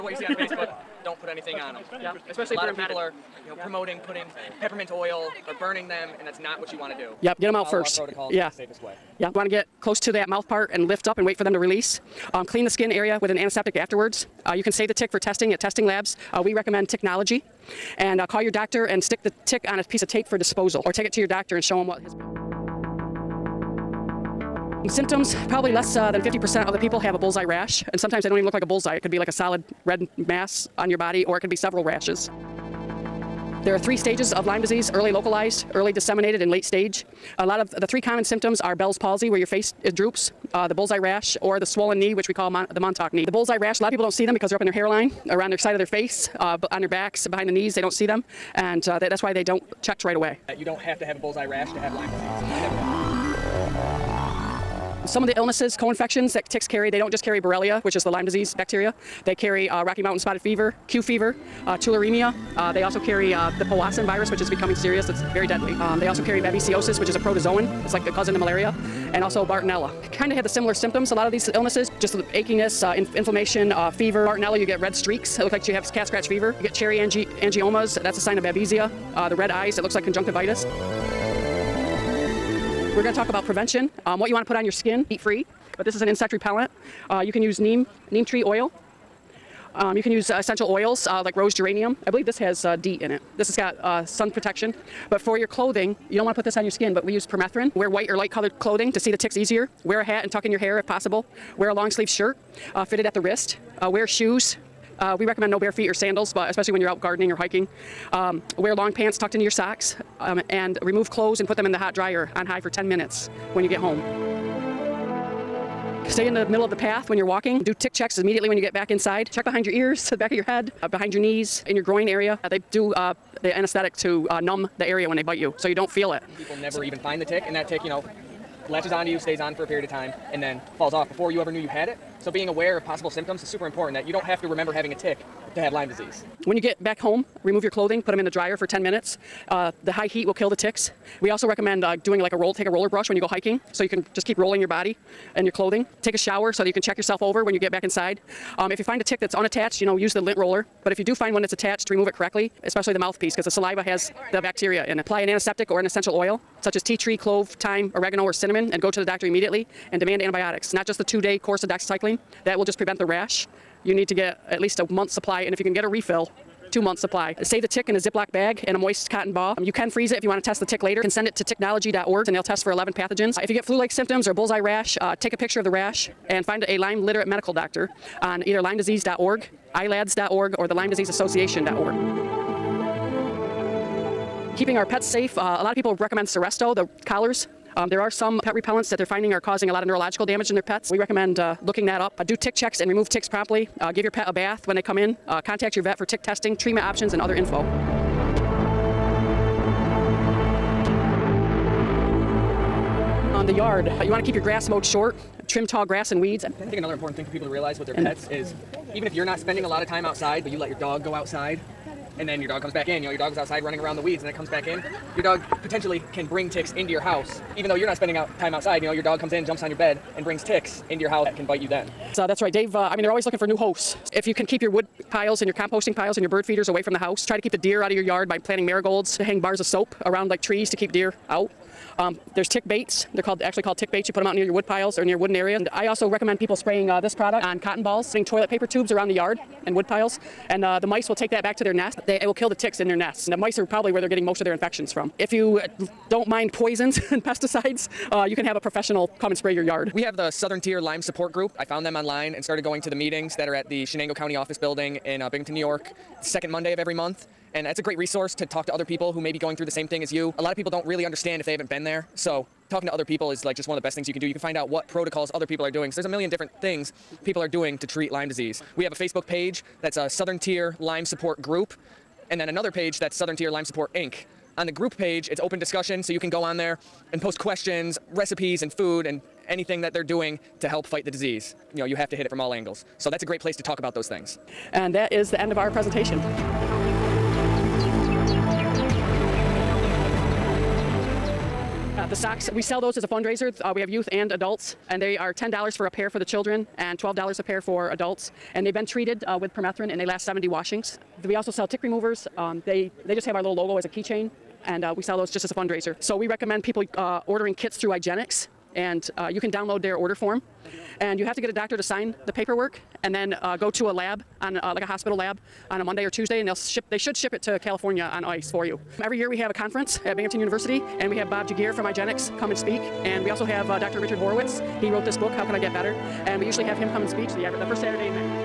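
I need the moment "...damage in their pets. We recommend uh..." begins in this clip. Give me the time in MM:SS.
03:10.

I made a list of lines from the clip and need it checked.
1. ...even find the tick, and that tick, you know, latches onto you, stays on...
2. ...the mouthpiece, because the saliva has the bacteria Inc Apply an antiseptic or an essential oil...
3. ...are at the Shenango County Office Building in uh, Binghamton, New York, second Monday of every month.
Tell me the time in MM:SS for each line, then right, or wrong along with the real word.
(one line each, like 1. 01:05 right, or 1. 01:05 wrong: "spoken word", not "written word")
1. 02:06 right
2. 02:32 wrong: "And", not "Inc"
3. 04:13 right.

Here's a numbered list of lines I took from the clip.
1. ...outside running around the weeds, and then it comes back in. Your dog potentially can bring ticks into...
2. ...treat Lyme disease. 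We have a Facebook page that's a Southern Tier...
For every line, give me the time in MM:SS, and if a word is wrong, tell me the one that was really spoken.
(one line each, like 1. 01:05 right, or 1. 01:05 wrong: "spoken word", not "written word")
1. 03:33 right
2. 04:27 right.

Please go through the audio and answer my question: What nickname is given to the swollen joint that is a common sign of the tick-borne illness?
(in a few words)
Montauk knee.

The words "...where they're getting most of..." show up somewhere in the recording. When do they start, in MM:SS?
04:03.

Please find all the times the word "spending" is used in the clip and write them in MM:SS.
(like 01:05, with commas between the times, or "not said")
03:29, 03:37.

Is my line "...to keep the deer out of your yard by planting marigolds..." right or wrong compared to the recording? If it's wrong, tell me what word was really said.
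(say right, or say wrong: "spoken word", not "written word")
right.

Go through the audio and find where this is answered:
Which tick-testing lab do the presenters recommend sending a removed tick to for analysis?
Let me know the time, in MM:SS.
00:16.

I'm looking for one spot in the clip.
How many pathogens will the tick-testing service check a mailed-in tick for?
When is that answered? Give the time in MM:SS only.
02:52.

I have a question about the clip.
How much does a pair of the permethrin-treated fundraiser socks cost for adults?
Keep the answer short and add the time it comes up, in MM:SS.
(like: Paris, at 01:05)
$12, at 04:56.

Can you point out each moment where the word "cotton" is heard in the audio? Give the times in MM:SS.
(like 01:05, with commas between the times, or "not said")
02:49, 03:57.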